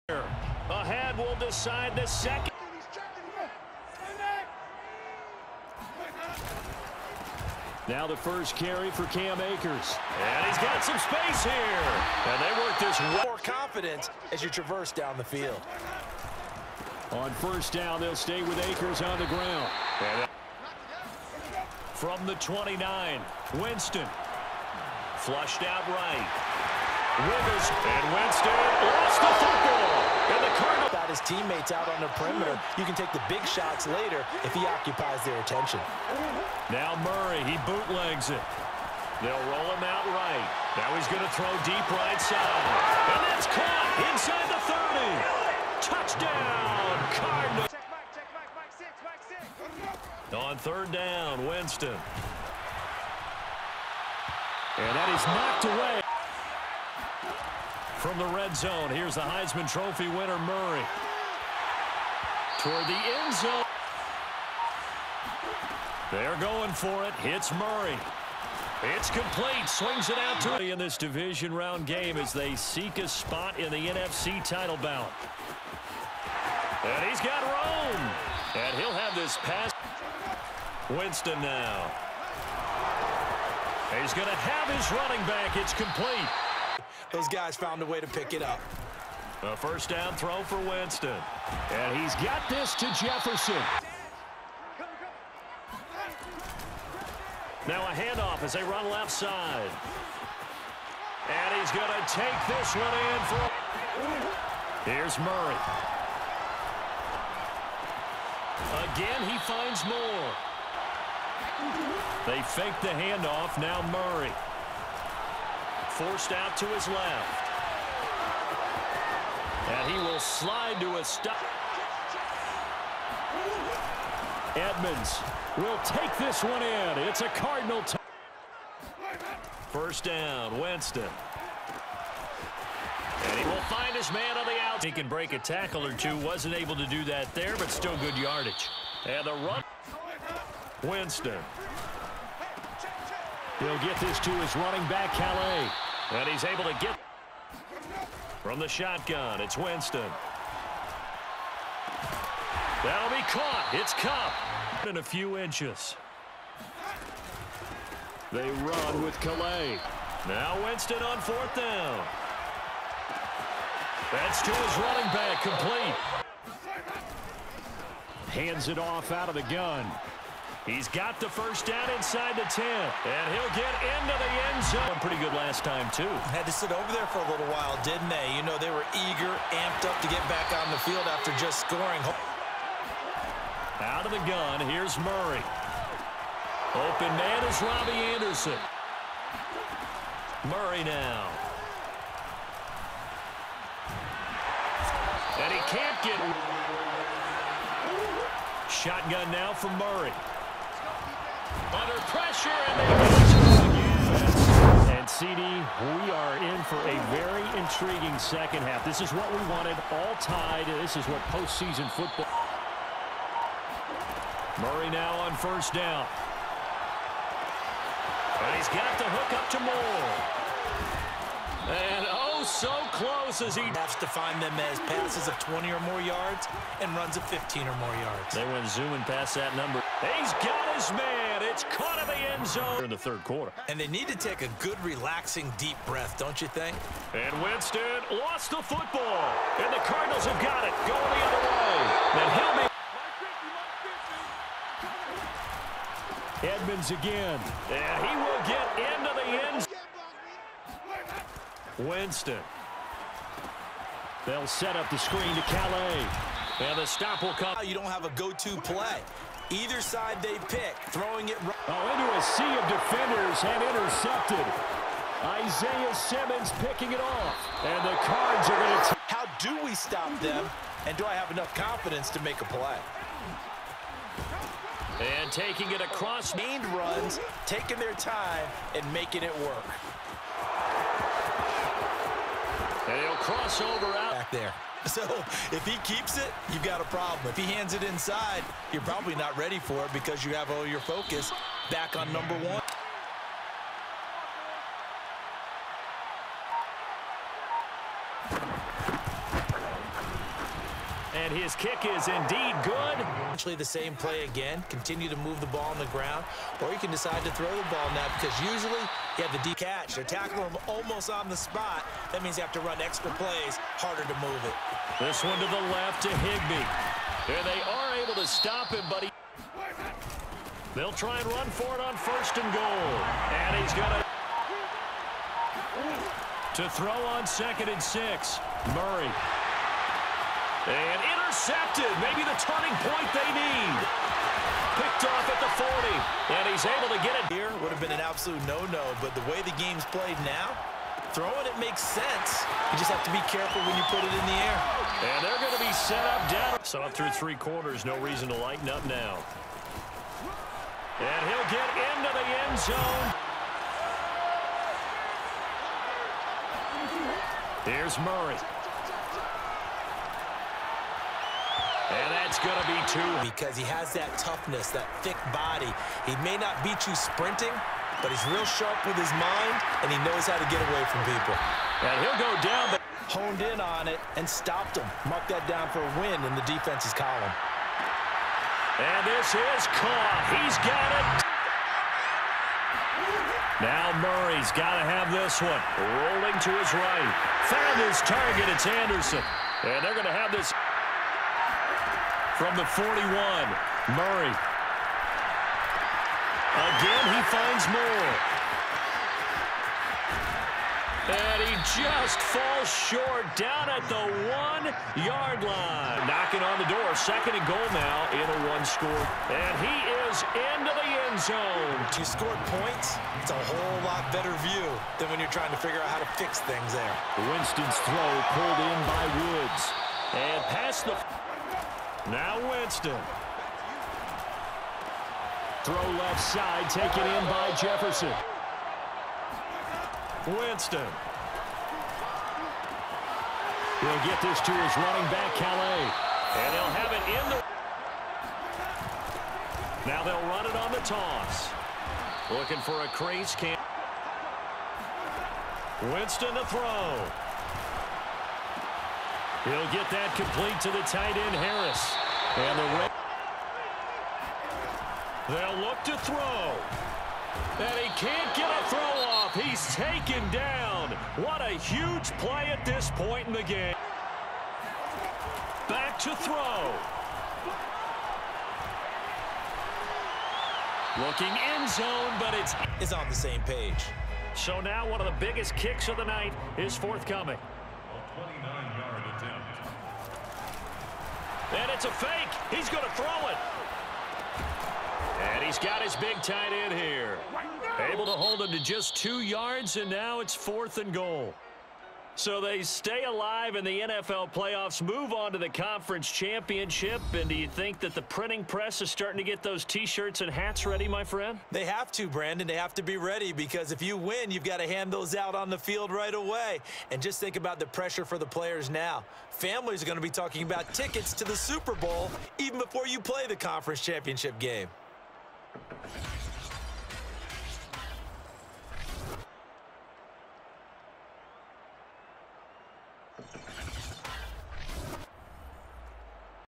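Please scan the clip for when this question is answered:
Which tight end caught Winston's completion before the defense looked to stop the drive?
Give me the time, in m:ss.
7:31.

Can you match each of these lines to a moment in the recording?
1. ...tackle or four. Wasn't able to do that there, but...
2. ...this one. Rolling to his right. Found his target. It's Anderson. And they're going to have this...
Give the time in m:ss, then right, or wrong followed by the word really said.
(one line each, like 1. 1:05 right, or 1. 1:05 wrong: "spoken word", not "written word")
1. 2:15 wrong: "two", not "four"
2. 6:25 right.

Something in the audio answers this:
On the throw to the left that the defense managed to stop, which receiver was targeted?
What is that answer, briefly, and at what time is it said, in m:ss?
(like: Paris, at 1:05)
Higbee, at 5:16.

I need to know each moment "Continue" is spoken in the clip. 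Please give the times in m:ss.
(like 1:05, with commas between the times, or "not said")
5:04.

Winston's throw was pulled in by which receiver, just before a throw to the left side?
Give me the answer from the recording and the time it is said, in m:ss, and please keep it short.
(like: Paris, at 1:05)
Woods, at 6:59.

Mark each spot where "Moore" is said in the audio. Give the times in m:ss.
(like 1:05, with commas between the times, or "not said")
1:49, 3:39, 6:37.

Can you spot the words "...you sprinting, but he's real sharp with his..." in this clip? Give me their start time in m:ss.
6:06.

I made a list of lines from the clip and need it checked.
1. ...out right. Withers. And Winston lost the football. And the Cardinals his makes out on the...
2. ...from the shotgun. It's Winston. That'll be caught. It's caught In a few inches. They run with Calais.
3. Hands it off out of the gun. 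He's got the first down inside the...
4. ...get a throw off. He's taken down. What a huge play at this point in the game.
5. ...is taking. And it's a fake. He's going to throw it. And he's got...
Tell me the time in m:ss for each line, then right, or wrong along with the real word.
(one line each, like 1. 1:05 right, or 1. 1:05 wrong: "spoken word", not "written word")
1. 0:25 wrong: "teammates", not "makes"
2. 2:28 right
3. 2:48 right
4. 7:38 right
5. 7:56 wrong: "forthcoming", not "taking".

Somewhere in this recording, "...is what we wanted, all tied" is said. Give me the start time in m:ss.
3:29.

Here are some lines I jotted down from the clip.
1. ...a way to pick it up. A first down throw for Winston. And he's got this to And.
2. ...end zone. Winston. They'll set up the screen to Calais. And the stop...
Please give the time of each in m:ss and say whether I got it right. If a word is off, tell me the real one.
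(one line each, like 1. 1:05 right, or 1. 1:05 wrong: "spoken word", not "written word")
1. 1:27 wrong: "Jefferson", not "And"
2. 4:09 right.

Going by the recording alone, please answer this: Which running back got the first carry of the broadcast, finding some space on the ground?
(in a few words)
Cam Akers.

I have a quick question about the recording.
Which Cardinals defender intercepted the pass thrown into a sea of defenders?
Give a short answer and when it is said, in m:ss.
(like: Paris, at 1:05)
Isaiah Simmons, at 4:25.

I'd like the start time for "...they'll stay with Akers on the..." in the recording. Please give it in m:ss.
0:17.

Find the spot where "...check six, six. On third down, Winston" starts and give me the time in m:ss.
0:48.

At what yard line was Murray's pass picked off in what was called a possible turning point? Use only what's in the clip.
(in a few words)
40.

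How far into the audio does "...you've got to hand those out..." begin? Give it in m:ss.
8:24.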